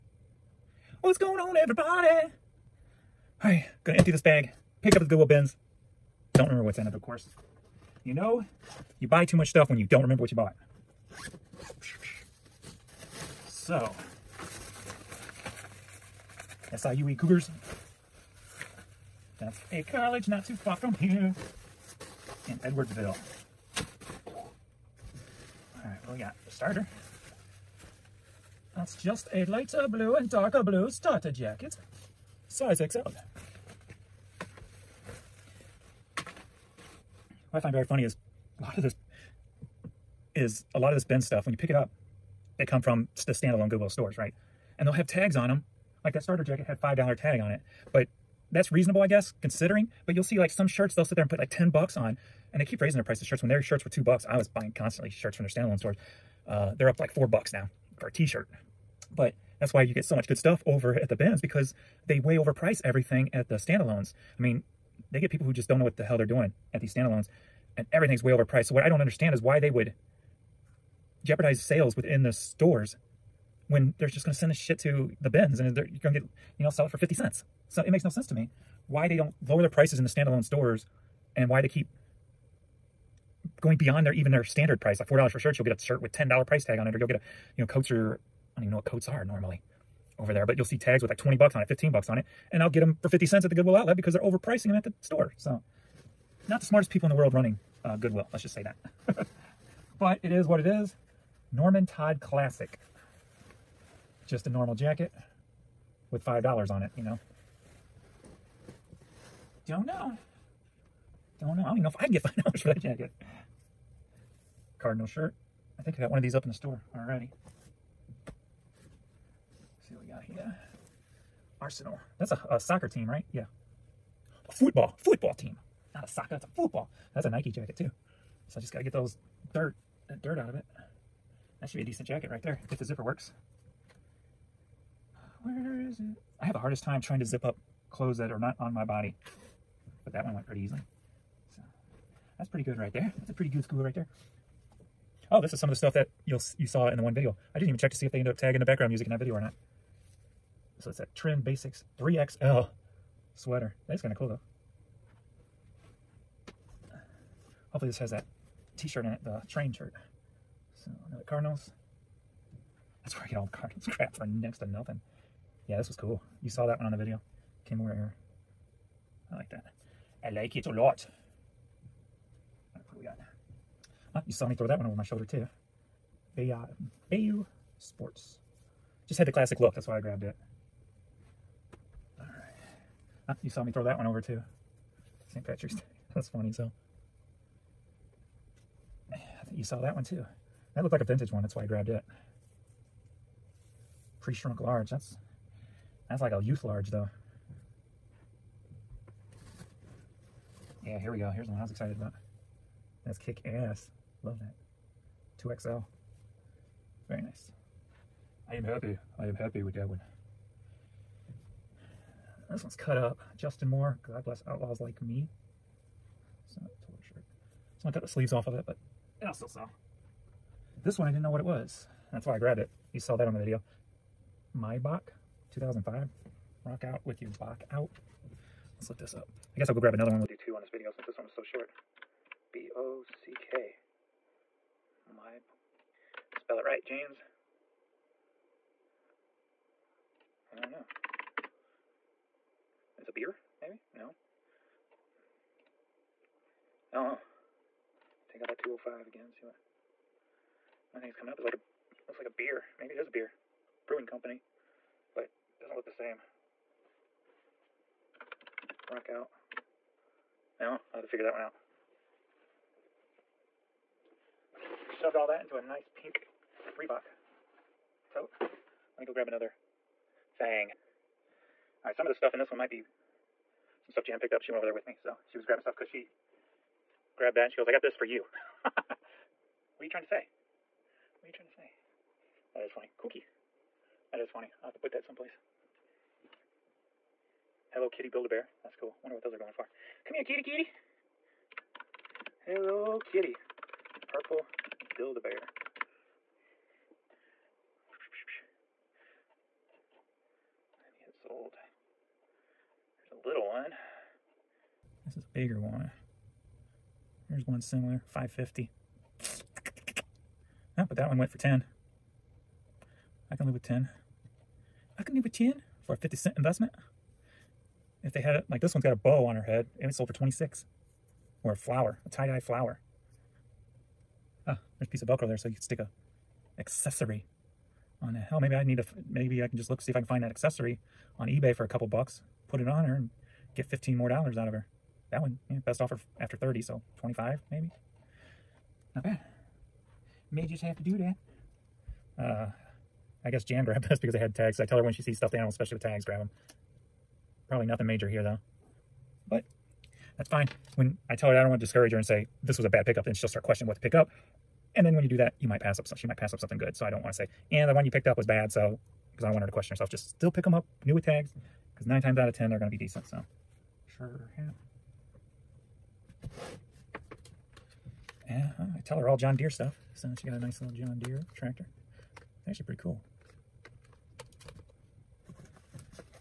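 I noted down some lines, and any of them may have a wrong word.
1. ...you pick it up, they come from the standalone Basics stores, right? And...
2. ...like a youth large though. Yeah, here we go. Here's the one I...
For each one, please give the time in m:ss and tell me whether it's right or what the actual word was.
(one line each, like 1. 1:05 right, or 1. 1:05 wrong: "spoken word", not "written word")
1. 0:41 wrong: "Goodwill", not "Basics"
2. 3:16 right.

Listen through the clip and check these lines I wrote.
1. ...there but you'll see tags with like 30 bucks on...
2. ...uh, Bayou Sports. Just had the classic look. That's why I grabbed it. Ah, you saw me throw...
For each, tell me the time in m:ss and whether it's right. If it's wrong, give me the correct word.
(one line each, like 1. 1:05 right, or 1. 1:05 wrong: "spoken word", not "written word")
1. 1:30 wrong: "20", not "30"
2. 2:56 right.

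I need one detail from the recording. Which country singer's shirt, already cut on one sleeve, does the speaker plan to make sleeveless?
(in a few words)
Justin Moore.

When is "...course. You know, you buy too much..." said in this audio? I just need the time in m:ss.
0:07.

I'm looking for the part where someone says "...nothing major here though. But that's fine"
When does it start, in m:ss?
5:47.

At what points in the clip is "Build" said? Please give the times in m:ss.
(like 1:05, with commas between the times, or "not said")
4:48, 4:54.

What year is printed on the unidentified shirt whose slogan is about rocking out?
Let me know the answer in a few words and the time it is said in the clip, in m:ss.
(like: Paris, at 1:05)
2005, at 3:45.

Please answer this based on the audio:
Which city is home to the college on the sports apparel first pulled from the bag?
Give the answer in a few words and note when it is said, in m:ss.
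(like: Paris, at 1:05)
Edwardsville, at 0:22.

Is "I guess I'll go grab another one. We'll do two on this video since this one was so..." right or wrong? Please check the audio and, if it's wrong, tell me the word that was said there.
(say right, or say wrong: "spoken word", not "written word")
right.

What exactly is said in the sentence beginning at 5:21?
Or a flower, a tie-dye flower.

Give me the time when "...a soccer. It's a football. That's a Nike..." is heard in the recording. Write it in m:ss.
2:06.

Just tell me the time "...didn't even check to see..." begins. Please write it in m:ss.
2:27.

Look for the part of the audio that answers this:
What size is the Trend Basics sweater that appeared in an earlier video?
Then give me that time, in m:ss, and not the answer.
2:31.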